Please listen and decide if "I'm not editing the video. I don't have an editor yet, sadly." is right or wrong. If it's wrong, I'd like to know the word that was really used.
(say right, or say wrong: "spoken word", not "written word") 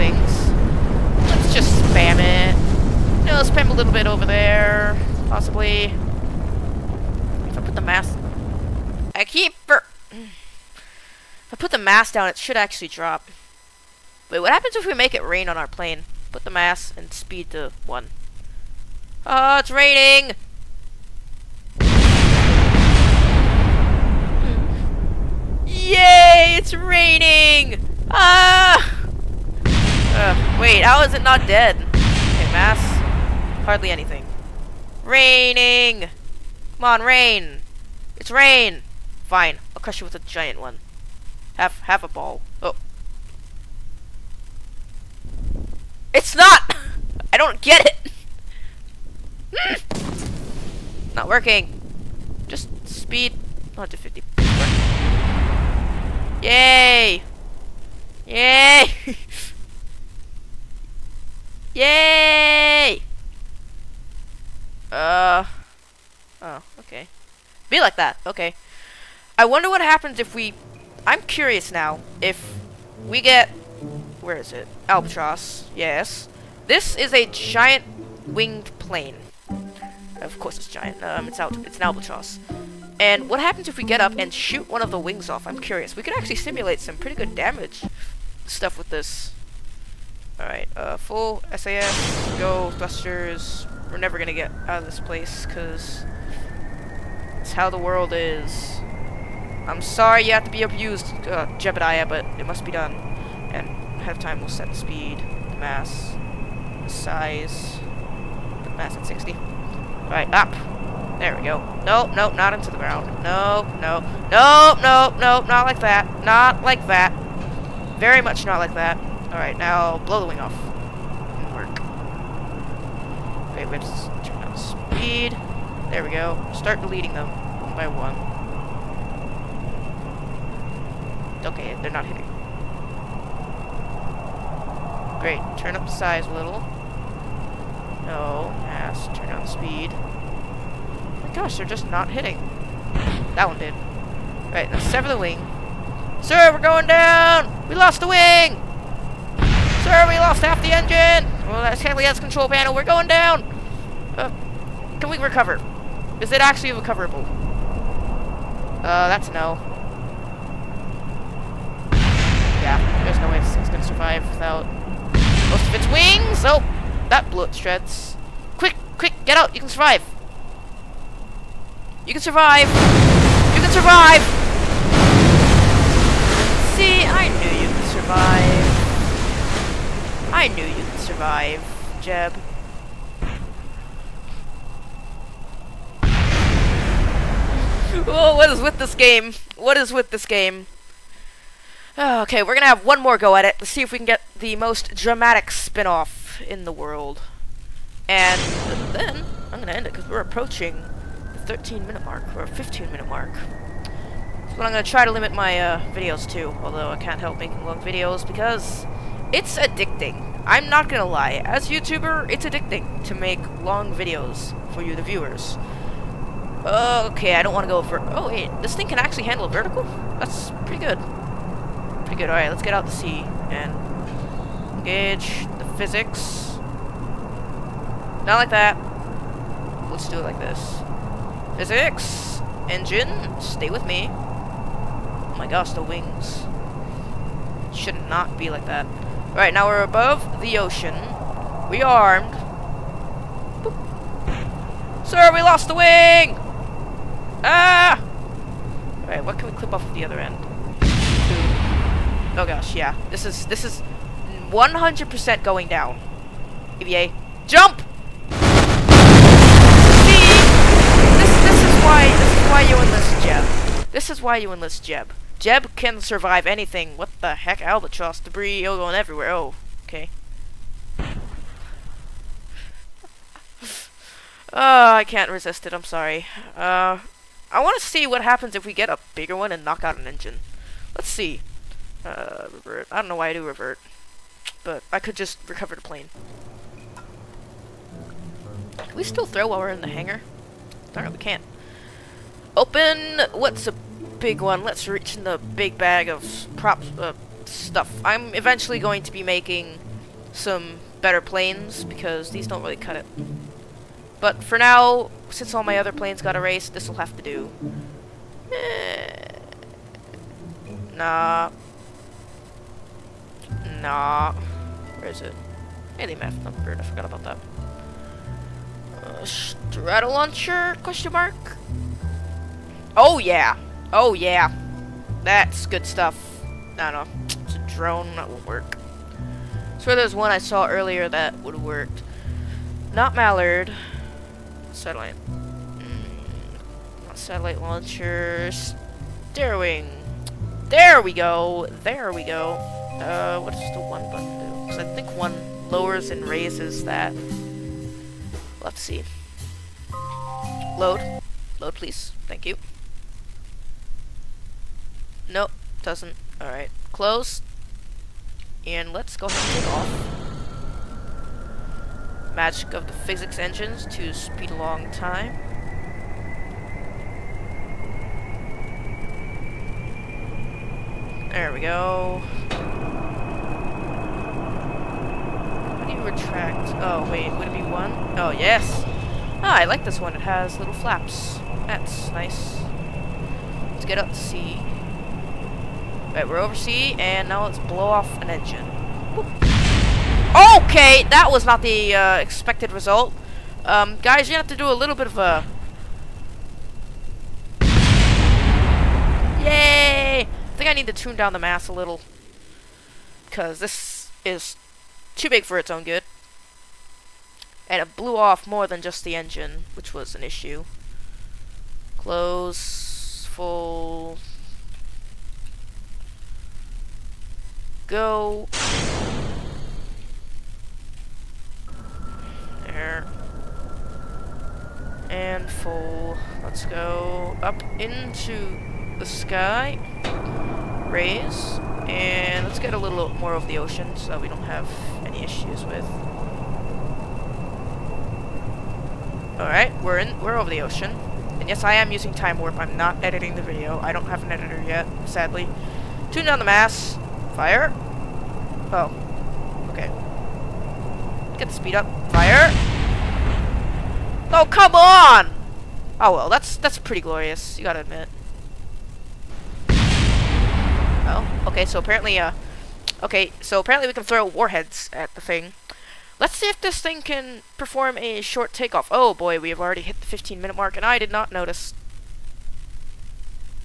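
right.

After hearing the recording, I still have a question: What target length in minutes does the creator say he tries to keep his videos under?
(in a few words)
15.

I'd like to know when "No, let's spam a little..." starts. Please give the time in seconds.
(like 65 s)
3 s.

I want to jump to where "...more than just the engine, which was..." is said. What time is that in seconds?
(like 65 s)
408 s.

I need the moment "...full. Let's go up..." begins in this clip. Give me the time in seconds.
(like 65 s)
425 s.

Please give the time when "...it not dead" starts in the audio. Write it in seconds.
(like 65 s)
31 s.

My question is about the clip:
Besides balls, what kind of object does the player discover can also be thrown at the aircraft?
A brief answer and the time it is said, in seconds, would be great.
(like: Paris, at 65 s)
warheads, at 464 s.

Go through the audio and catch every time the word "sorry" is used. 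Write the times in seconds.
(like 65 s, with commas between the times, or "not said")
99 s, 275 s.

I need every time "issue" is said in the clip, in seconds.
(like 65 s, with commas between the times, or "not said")
410 s, 435 s.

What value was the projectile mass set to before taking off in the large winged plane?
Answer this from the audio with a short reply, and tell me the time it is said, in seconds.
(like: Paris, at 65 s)
60, at 109 s.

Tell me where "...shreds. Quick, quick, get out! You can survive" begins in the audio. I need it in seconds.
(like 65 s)
167 s.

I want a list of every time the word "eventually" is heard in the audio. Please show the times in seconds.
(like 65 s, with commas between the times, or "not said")
298 s.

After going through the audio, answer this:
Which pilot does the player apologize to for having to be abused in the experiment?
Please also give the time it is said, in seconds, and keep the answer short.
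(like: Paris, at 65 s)
Jebediah, at 101 s.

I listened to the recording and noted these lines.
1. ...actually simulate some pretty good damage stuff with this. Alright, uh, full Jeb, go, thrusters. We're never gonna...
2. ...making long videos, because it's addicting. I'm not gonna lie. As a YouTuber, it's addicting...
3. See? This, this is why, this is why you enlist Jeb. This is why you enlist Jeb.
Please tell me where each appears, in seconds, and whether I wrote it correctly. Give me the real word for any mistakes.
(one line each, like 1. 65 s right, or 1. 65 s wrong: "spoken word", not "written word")
1. 86 s wrong: "SAS", not "Jeb"
2. 207 s right
3. 260 s right.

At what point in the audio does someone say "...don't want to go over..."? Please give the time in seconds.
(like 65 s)
217 s.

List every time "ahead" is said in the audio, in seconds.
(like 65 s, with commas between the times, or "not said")
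104 s, 359 s.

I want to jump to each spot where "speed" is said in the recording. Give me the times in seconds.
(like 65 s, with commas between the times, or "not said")
17 s, 52 s, 104 s, 124 s, 139 s, 364 s, 451 s.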